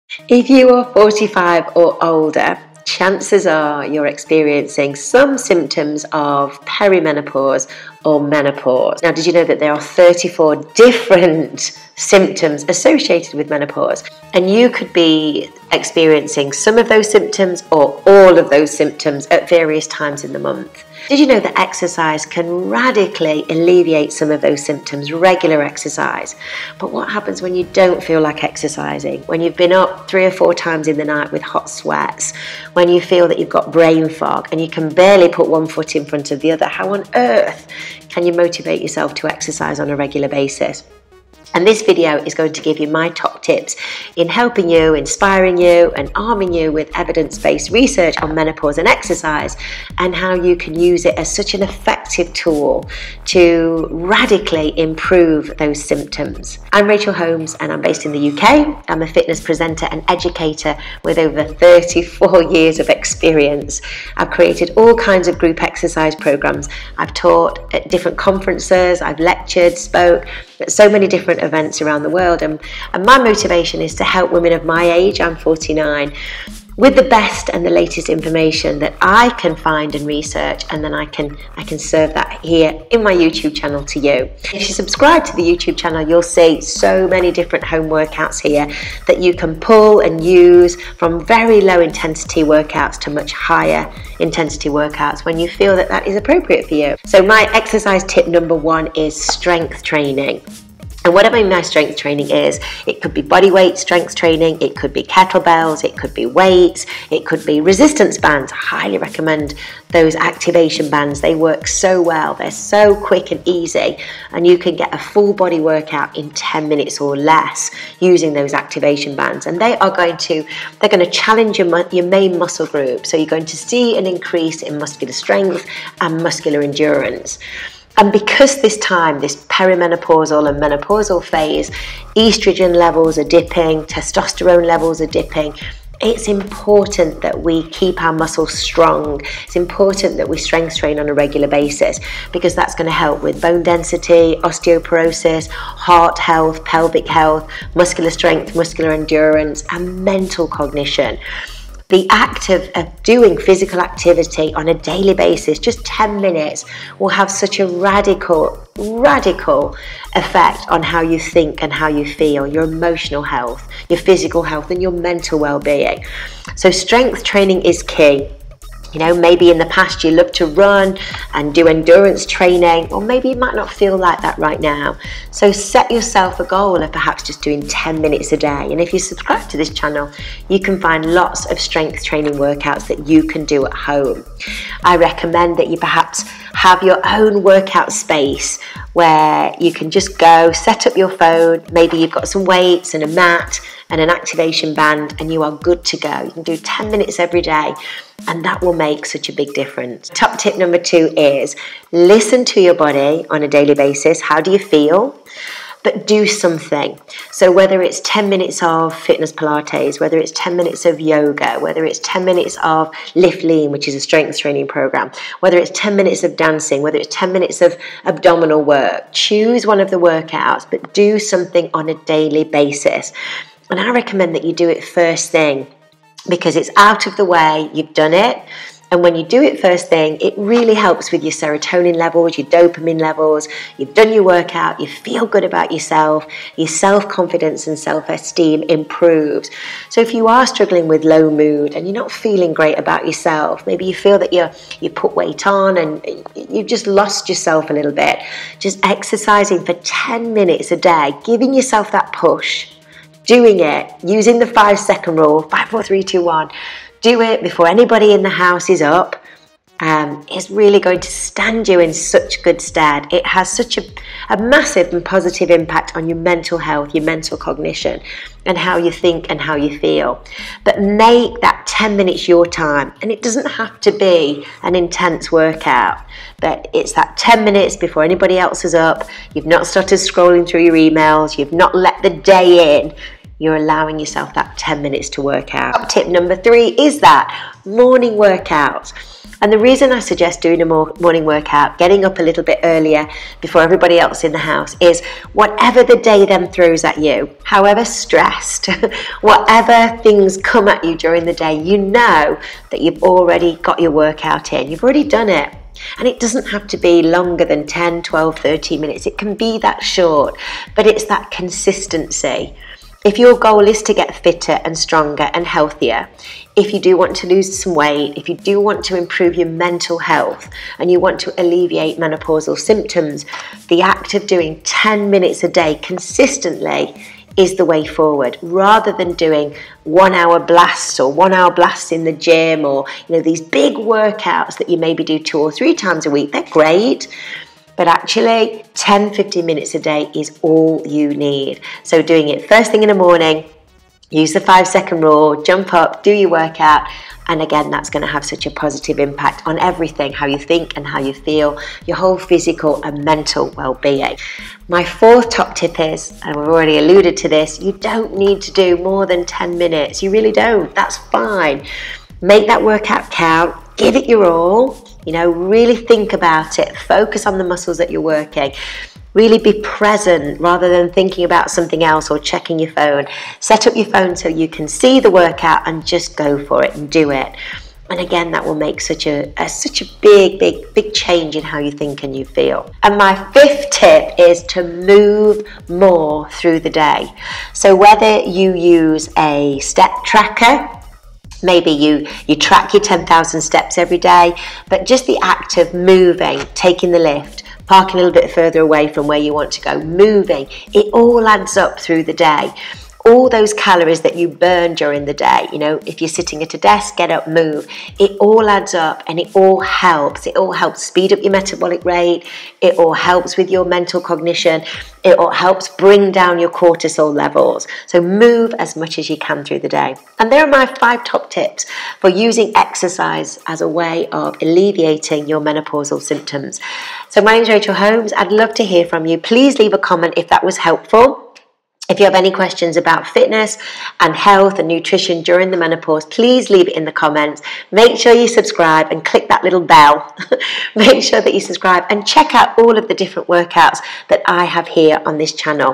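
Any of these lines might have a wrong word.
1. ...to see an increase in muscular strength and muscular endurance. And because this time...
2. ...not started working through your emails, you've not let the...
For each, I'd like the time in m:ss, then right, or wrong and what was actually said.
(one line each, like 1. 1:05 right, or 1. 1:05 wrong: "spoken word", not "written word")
1. 2:03 right
2. 4:39 wrong: "scrolling", not "working".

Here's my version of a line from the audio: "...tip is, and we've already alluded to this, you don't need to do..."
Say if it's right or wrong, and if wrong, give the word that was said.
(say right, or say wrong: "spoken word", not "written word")
right.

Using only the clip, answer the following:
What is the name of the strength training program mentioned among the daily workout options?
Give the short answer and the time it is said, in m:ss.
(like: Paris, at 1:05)
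Lift Lean, at 3:33.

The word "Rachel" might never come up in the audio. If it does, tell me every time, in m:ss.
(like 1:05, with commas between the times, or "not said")
0:56, 7:07.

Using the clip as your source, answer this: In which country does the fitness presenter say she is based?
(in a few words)
UK.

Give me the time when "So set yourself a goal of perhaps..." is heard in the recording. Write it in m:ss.
2:55.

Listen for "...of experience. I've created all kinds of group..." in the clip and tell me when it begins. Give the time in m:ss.
1:02.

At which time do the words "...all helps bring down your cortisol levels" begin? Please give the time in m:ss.
6:55.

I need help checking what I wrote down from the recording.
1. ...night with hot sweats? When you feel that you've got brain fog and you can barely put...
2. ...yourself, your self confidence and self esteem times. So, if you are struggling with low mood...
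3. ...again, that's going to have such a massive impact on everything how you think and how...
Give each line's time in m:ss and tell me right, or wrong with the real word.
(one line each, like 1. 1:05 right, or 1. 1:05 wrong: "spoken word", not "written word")
1. 0:31 right
2. 3:55 wrong: "improves", not "times"
3. 5:47 wrong: "positive", not "massive".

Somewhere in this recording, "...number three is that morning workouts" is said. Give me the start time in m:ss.
4:46.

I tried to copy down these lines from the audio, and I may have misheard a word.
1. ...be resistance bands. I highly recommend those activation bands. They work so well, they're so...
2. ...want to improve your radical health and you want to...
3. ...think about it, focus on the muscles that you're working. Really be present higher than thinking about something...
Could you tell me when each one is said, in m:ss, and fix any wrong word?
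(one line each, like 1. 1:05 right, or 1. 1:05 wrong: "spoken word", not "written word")
1. 1:47 right
2. 5:18 wrong: "mental", not "radical"
3. 6:05 wrong: "rather", not "higher".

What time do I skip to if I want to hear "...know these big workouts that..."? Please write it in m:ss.
5:33.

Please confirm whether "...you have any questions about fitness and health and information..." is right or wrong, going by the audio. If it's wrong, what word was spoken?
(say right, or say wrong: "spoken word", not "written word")
wrong: "nutrition", not "information".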